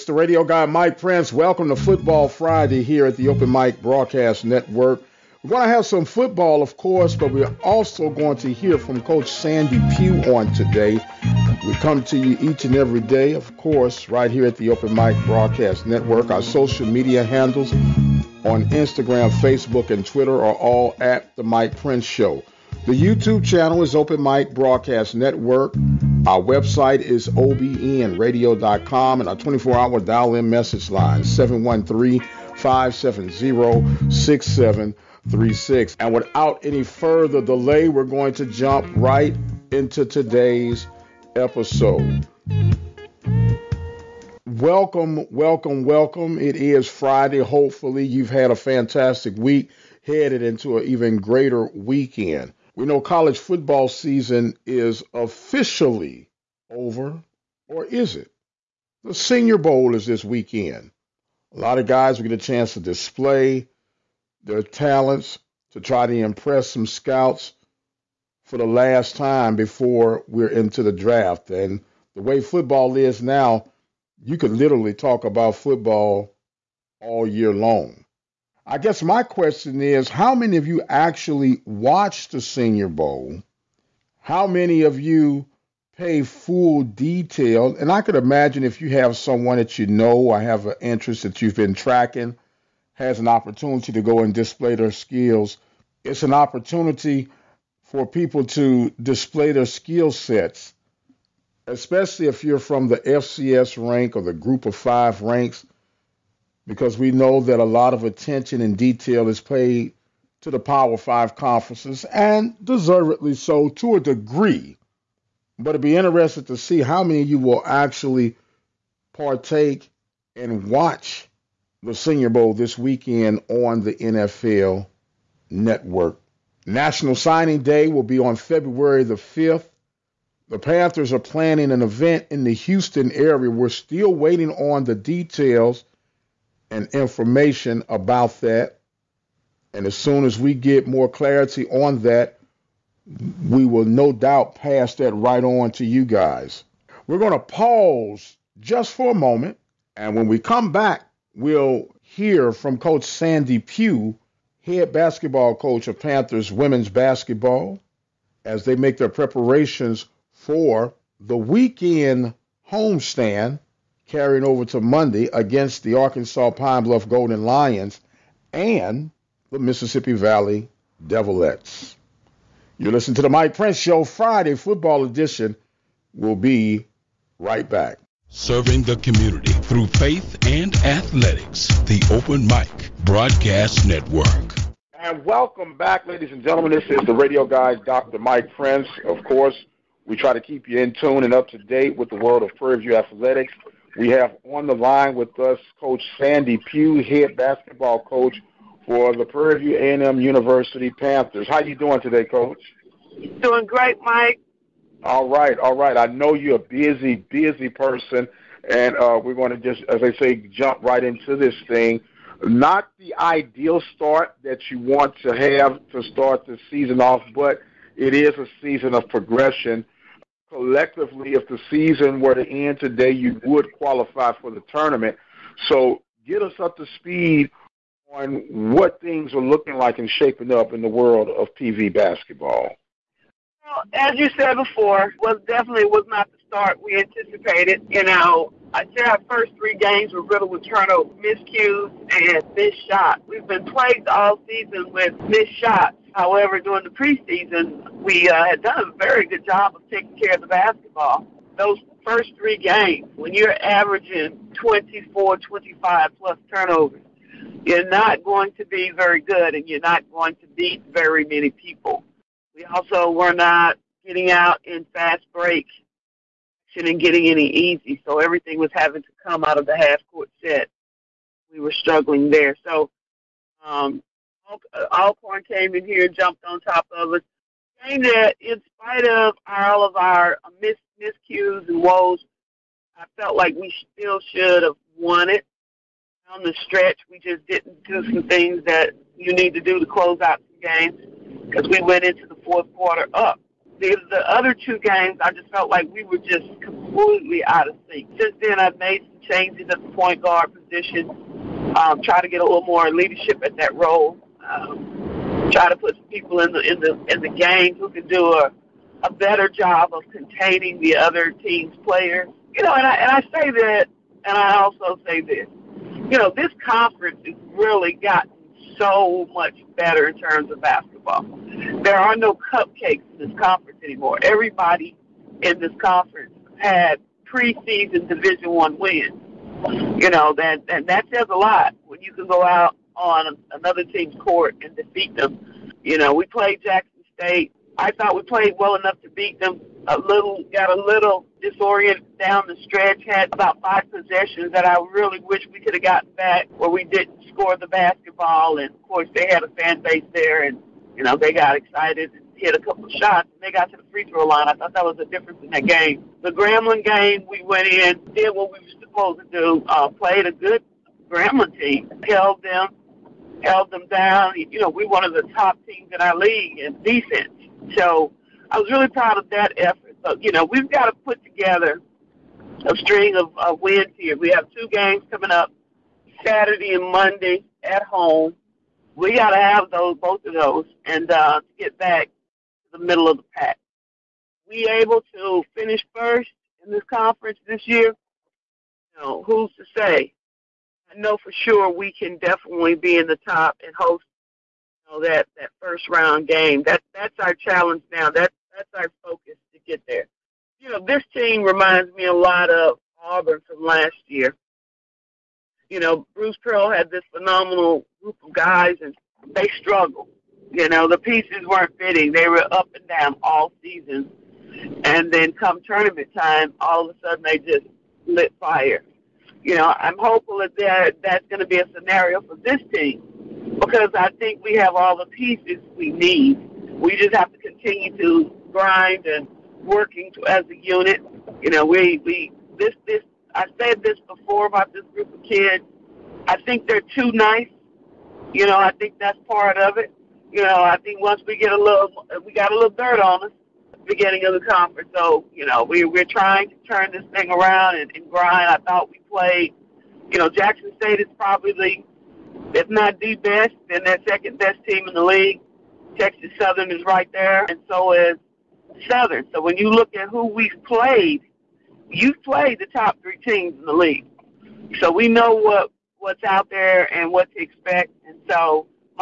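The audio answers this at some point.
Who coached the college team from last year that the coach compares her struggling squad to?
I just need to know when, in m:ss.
6:46.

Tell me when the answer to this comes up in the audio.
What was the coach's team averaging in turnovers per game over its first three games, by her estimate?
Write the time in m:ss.
4:14.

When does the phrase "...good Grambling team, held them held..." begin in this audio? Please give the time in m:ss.
6:00.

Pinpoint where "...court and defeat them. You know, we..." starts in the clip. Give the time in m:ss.
5:34.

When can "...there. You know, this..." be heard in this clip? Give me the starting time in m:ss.
6:39.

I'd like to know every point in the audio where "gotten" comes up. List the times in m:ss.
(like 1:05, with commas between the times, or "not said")
5:17, 5:45.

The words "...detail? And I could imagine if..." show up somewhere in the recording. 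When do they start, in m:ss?
1:26.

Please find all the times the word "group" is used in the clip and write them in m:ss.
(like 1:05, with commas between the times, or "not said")
1:44, 6:48, 7:14.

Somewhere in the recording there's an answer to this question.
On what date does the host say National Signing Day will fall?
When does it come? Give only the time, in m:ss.
2:08.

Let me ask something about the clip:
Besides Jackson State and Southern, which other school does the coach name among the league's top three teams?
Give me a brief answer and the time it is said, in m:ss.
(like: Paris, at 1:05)
Texas Southern, at 7:35.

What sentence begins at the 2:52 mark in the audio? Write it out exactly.
You listen to the Mike Prince Show Friday Football Edition.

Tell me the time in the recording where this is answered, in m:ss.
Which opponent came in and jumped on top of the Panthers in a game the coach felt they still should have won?
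4:34.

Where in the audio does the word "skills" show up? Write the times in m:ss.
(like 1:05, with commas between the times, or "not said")
1:34, 1:39.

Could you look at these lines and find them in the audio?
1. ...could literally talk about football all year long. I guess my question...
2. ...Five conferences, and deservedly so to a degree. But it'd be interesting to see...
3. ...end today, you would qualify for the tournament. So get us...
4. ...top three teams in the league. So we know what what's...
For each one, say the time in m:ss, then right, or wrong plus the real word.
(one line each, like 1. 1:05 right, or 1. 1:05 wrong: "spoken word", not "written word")
1. 1:14 right
2. 1:50 right
3. 3:42 right
4. 7:42 right.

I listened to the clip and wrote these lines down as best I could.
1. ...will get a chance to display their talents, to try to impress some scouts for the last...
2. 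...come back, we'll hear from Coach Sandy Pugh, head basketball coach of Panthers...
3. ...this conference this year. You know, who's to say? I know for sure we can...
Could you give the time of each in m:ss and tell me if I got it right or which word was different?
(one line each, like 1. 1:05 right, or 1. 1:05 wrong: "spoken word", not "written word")
1. 1:02 right
2. 2:30 right
3. 6:26 right.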